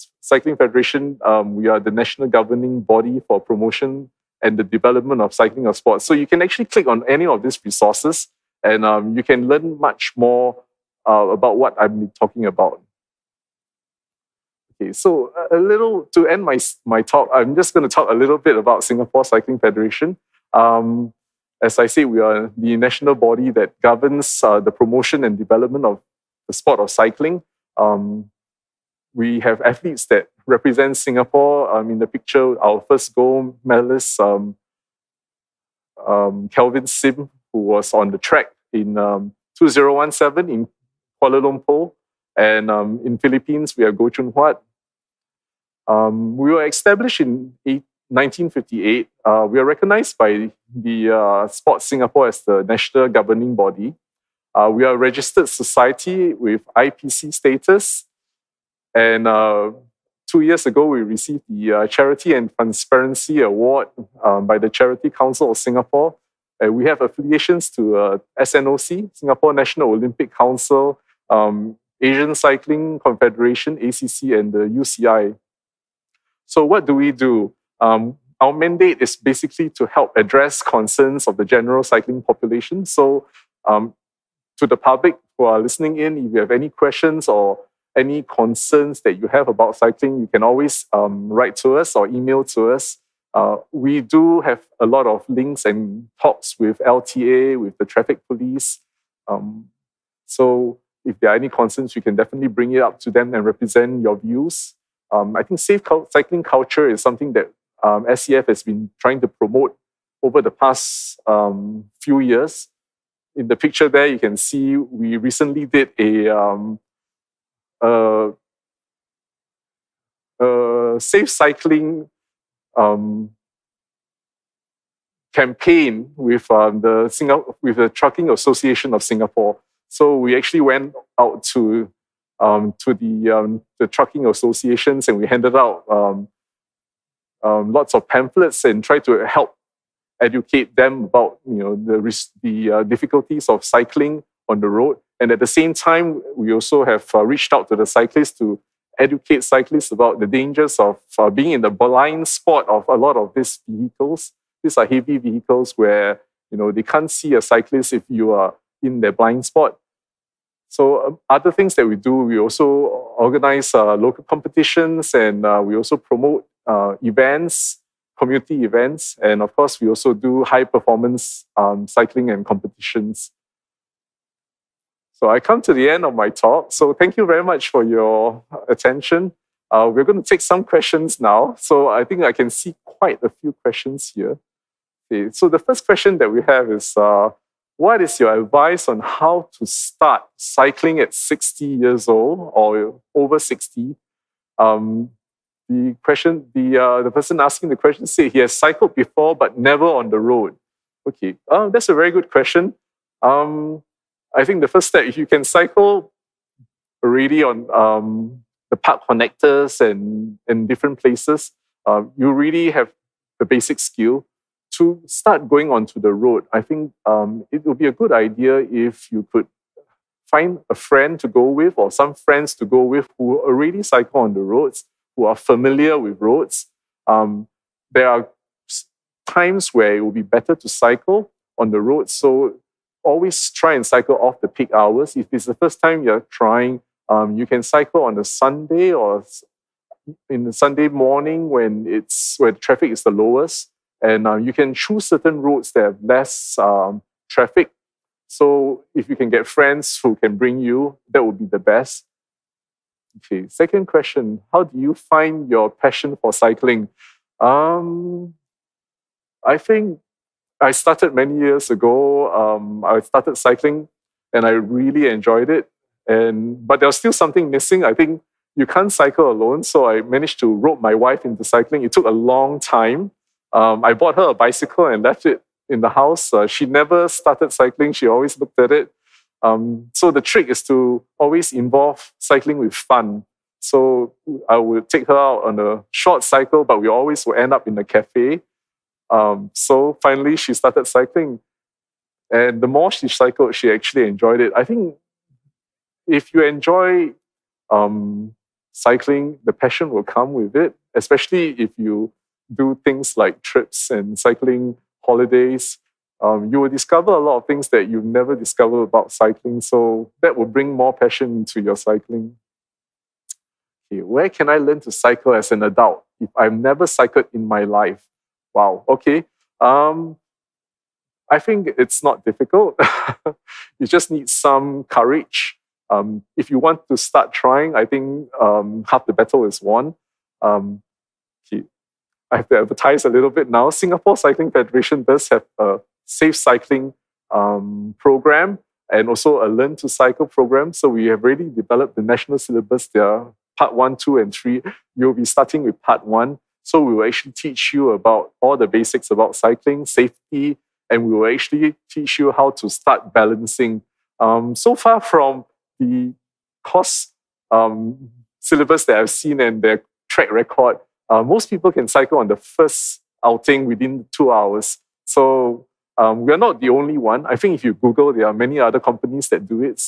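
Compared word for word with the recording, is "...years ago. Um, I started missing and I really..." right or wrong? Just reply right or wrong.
wrong.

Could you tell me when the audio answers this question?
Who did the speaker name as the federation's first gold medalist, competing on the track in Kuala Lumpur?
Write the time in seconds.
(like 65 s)
36 s.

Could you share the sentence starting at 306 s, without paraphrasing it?
Um, you will discover a lot of things that you never discovered about cycling.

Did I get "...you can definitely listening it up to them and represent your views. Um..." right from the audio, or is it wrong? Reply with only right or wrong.
wrong.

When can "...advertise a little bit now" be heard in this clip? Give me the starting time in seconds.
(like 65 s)
332 s.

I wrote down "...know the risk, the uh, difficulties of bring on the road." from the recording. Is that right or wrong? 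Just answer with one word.
wrong.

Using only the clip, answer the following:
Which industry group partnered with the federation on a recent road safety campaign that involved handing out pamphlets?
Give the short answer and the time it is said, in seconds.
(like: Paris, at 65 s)
Trucking Association of Singapore, at 127 s.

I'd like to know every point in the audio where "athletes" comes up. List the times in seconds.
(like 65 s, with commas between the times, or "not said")
29 s.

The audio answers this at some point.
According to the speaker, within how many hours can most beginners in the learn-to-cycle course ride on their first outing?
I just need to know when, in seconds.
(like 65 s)
364 s.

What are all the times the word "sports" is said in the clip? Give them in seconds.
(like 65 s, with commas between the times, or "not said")
5 s, 26 s, 51 s.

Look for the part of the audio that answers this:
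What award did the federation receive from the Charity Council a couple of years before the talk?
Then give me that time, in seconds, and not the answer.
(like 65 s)
61 s.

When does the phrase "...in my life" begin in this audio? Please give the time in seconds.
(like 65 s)
317 s.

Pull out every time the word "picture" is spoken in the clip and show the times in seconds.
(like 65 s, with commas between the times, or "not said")
32 s, 113 s.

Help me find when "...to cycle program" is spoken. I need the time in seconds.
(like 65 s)
339 s.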